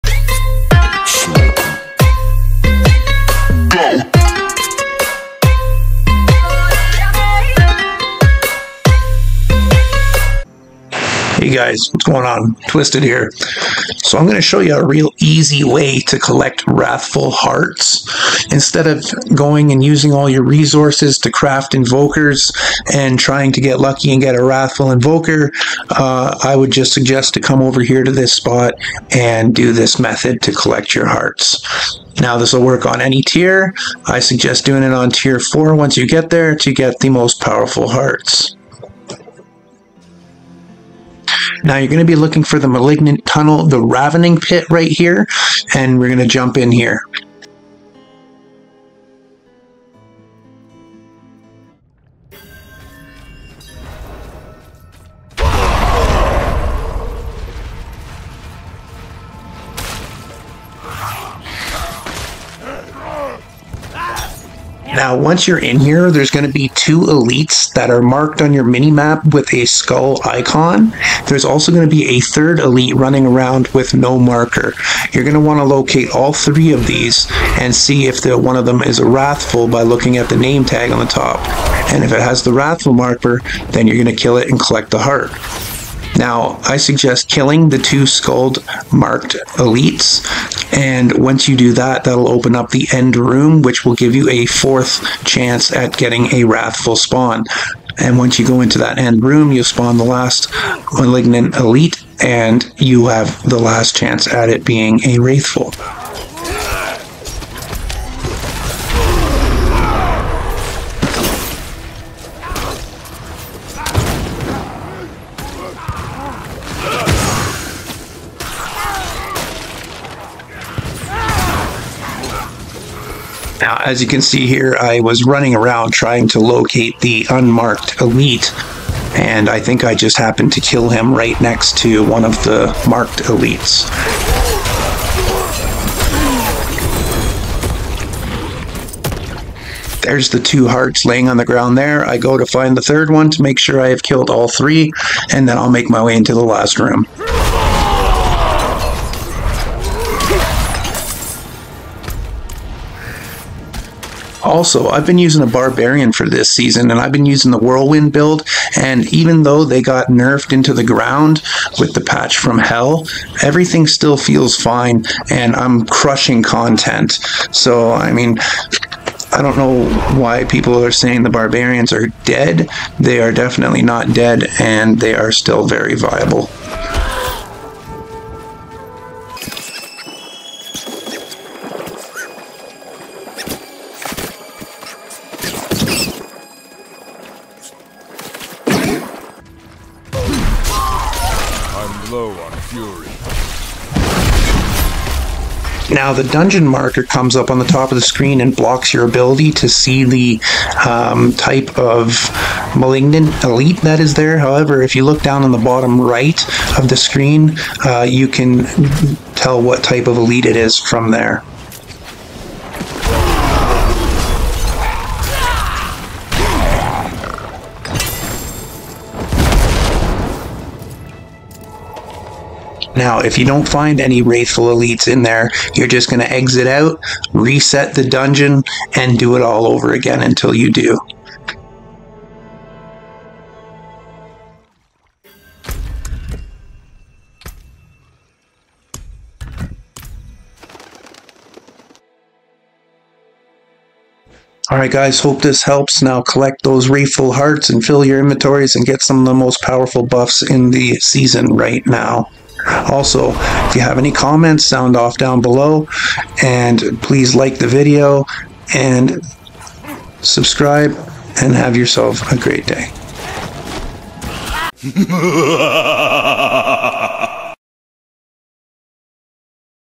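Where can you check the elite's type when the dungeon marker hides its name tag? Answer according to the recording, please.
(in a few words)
Bottom right.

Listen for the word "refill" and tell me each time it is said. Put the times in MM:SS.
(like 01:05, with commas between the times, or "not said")
04:06.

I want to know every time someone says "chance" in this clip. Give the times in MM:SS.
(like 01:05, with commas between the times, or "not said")
01:35, 01:43.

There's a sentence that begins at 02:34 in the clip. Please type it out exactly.
Also, I've been using a Barbarian for this season, and I've been using the Whirlwind build.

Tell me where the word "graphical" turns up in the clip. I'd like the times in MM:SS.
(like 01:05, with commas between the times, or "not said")
not said.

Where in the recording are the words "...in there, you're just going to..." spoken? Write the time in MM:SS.
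03:45.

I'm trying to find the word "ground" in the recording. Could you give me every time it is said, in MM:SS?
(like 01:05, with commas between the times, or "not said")
02:21, 02:40.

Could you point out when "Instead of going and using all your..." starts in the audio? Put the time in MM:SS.
00:18.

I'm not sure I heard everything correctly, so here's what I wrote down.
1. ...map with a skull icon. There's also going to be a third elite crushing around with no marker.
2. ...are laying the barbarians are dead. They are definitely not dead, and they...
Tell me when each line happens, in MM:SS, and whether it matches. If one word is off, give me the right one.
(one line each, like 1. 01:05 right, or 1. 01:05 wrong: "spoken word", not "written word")
1. 01:08 wrong: "running", not "crushing"
2. 02:50 wrong: "saying", not "laying".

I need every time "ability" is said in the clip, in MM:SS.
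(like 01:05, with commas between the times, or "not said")
03:19.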